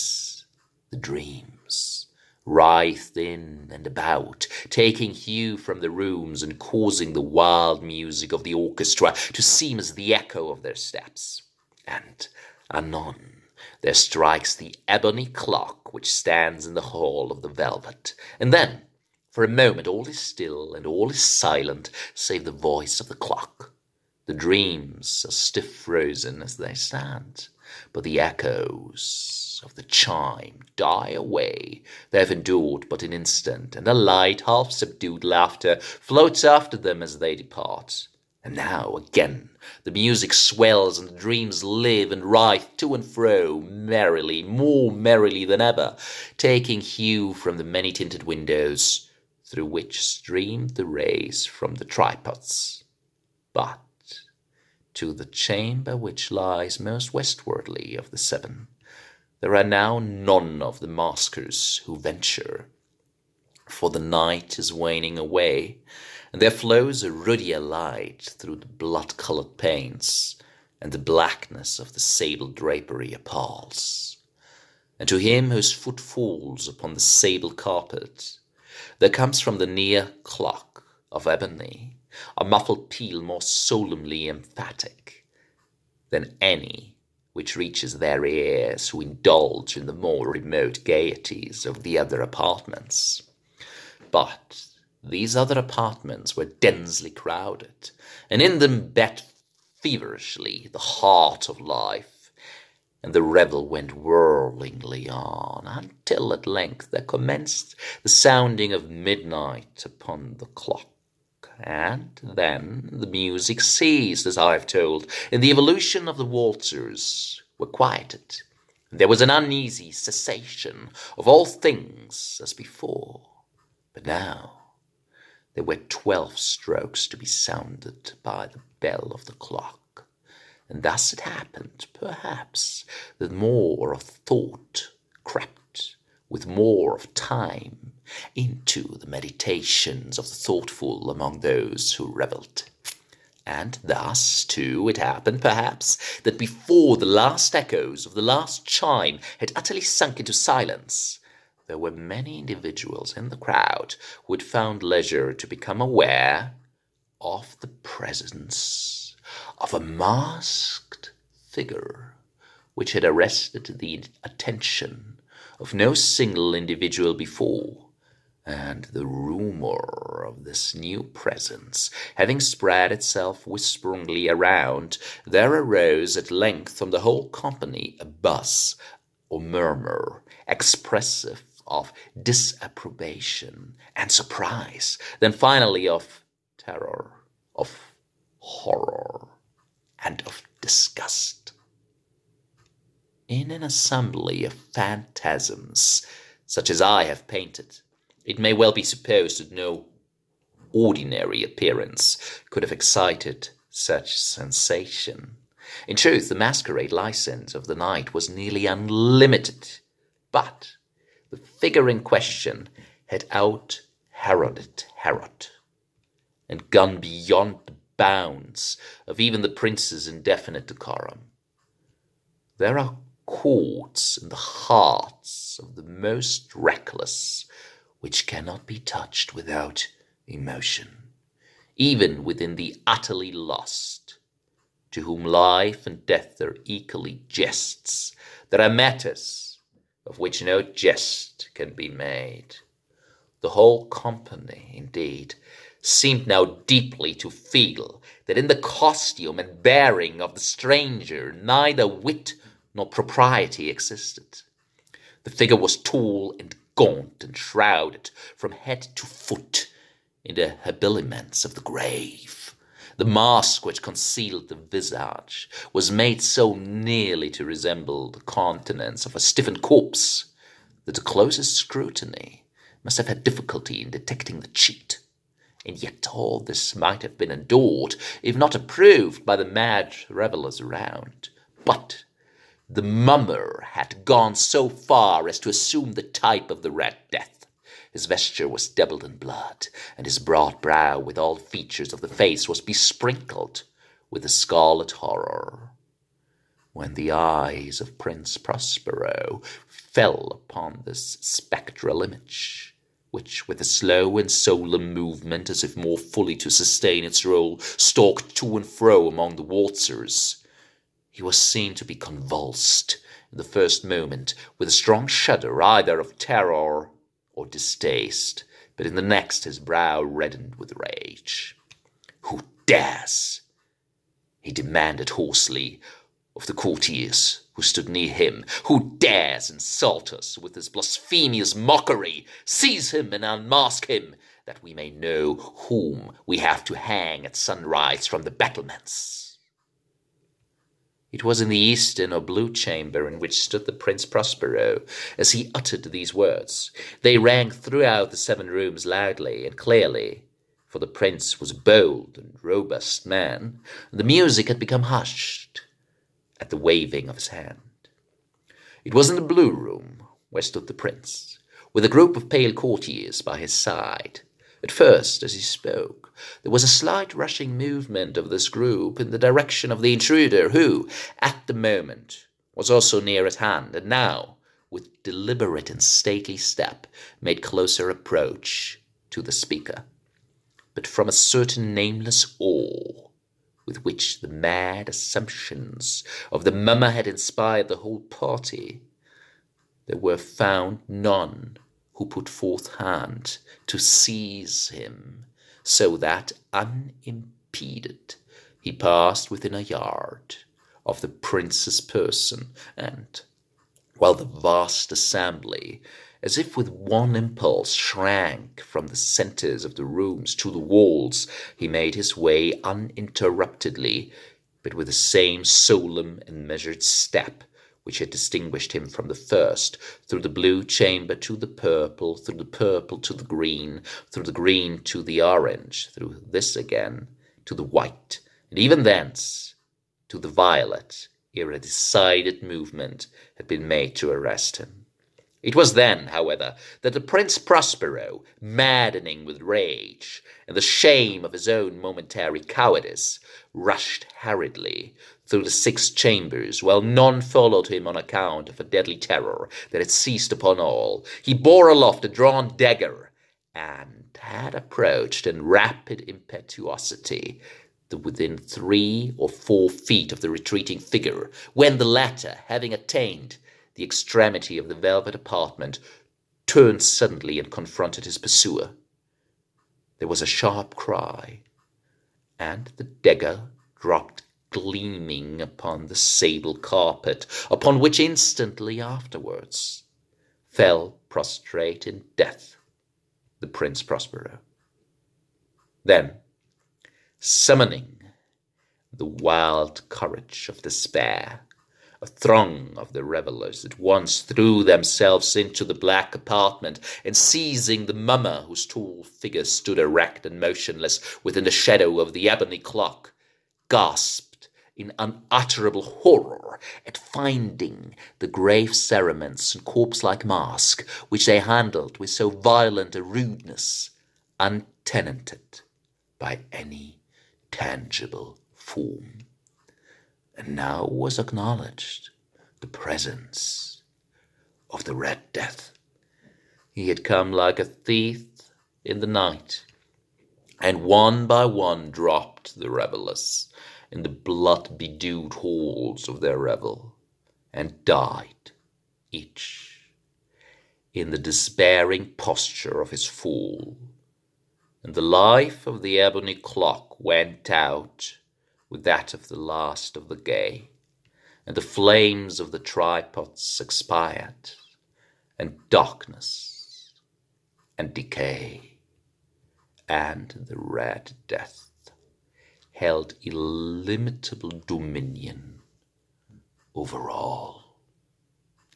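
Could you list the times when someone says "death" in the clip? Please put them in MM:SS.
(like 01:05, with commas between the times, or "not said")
03:56, 04:47, 08:02, 08:45, 09:21.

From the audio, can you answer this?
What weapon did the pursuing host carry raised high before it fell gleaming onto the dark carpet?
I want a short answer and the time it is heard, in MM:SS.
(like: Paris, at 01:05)
a drawn dagger, at 07:32.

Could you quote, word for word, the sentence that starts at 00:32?
They have endured but an instant, and a light, half subdued laughter floats after them as they depart.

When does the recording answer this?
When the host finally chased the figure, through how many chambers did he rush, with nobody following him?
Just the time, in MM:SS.
07:25.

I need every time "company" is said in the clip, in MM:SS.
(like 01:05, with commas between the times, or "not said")
02:57, 04:03.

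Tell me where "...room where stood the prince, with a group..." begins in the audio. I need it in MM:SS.
05:59.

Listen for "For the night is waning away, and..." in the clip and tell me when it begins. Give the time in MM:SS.
01:03.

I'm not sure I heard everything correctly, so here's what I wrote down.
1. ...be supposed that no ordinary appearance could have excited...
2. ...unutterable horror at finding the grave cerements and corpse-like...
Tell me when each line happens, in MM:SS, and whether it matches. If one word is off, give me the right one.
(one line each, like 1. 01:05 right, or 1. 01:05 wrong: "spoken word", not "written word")
1. 03:18 right
2. 08:24 right.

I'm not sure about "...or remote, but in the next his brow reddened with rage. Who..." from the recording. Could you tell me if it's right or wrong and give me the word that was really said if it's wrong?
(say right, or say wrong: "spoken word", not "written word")
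wrong: "distaste", not "remote".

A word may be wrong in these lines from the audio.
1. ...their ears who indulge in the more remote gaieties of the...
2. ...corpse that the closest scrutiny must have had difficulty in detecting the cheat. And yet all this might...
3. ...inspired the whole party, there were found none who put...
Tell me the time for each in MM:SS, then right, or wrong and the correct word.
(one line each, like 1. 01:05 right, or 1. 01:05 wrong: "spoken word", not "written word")
1. 01:27 right
2. 04:29 right
3. 06:27 right.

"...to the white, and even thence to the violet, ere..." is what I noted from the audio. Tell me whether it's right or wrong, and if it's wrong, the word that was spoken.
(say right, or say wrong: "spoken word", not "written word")
right.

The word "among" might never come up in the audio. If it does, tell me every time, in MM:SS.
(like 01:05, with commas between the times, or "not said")
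02:21, 05:09.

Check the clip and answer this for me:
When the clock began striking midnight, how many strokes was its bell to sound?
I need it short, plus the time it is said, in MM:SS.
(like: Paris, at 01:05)
12, at 02:05.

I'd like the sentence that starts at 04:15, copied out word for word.
The figure was tall and gaunt and shrouded from head to foot in the habiliments of the grave.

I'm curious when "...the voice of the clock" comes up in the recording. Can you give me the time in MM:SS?
00:22.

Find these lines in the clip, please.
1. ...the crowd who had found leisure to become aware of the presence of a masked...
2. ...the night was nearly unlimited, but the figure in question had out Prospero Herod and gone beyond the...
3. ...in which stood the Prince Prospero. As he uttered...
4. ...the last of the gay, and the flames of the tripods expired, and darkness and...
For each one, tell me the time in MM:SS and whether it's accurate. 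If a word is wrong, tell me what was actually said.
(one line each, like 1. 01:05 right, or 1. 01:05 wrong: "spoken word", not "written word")
1. 02:33 right
2. 03:27 wrong: "Heroded", not "Prospero"
3. 05:43 right
4. 09:09 right.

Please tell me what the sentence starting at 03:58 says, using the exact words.
There are matters of which no jest can be made.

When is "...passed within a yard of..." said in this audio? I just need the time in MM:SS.
06:38.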